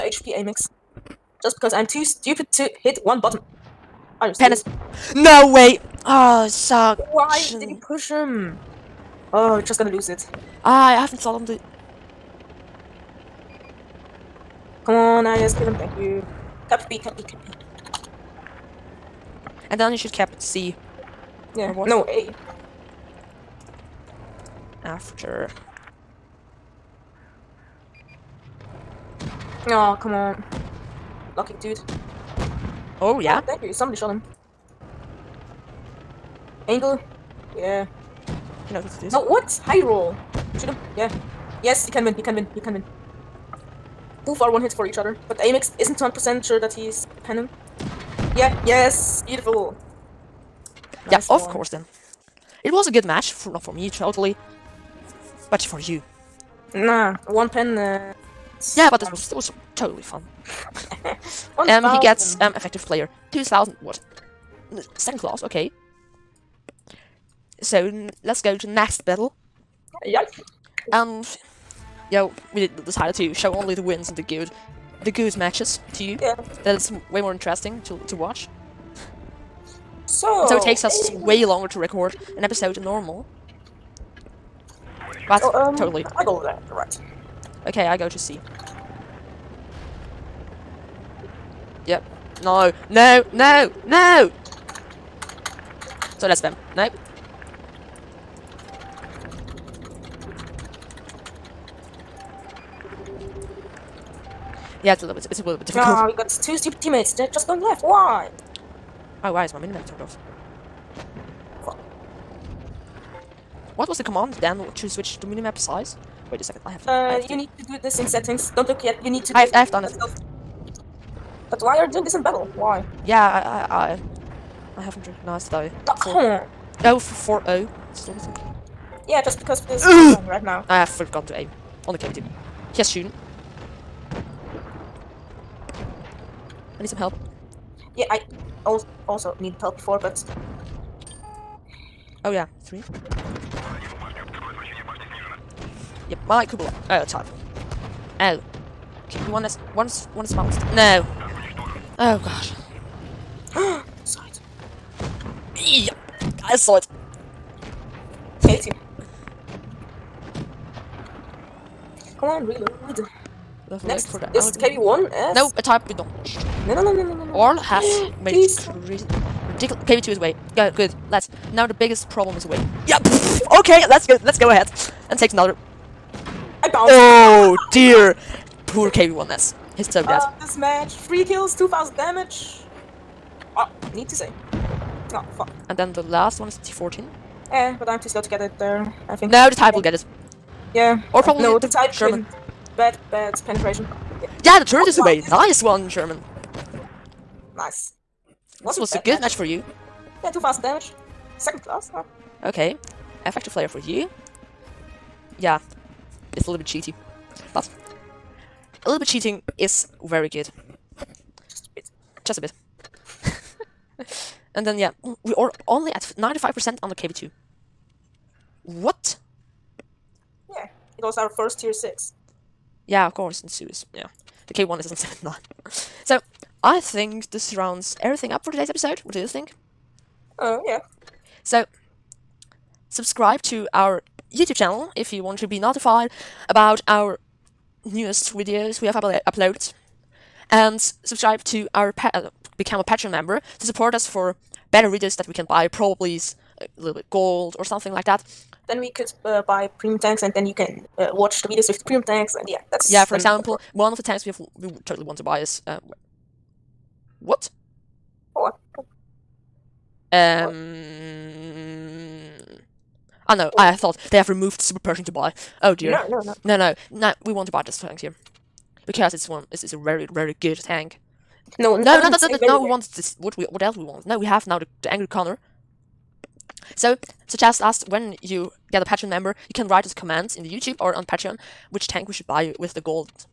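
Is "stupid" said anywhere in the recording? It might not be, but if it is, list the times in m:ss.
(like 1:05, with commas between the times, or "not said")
0:02, 1:46.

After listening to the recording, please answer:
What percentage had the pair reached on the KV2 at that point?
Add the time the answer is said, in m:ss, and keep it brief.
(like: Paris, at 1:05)
95%, at 3:36.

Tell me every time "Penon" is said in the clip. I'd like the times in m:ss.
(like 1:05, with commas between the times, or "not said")
0:47.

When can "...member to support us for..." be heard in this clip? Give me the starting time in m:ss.
4:03.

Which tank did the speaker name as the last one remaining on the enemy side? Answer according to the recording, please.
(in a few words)
T14.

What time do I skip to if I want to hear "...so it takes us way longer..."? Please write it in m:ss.
1:20.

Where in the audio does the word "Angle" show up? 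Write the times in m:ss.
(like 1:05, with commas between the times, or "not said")
0:36.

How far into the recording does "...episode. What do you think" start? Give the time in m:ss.
3:48.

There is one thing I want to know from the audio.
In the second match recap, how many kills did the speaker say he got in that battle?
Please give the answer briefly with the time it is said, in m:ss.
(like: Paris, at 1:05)
3, at 3:00.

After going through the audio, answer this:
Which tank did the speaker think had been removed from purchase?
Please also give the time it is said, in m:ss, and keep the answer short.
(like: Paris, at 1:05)
Super Pershing, at 4:24.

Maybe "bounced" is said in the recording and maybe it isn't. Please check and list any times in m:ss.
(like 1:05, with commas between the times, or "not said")
2:30, 2:56.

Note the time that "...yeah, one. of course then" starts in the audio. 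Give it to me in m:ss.
0:51.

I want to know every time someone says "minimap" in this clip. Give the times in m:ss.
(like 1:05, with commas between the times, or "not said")
1:49, 1:55.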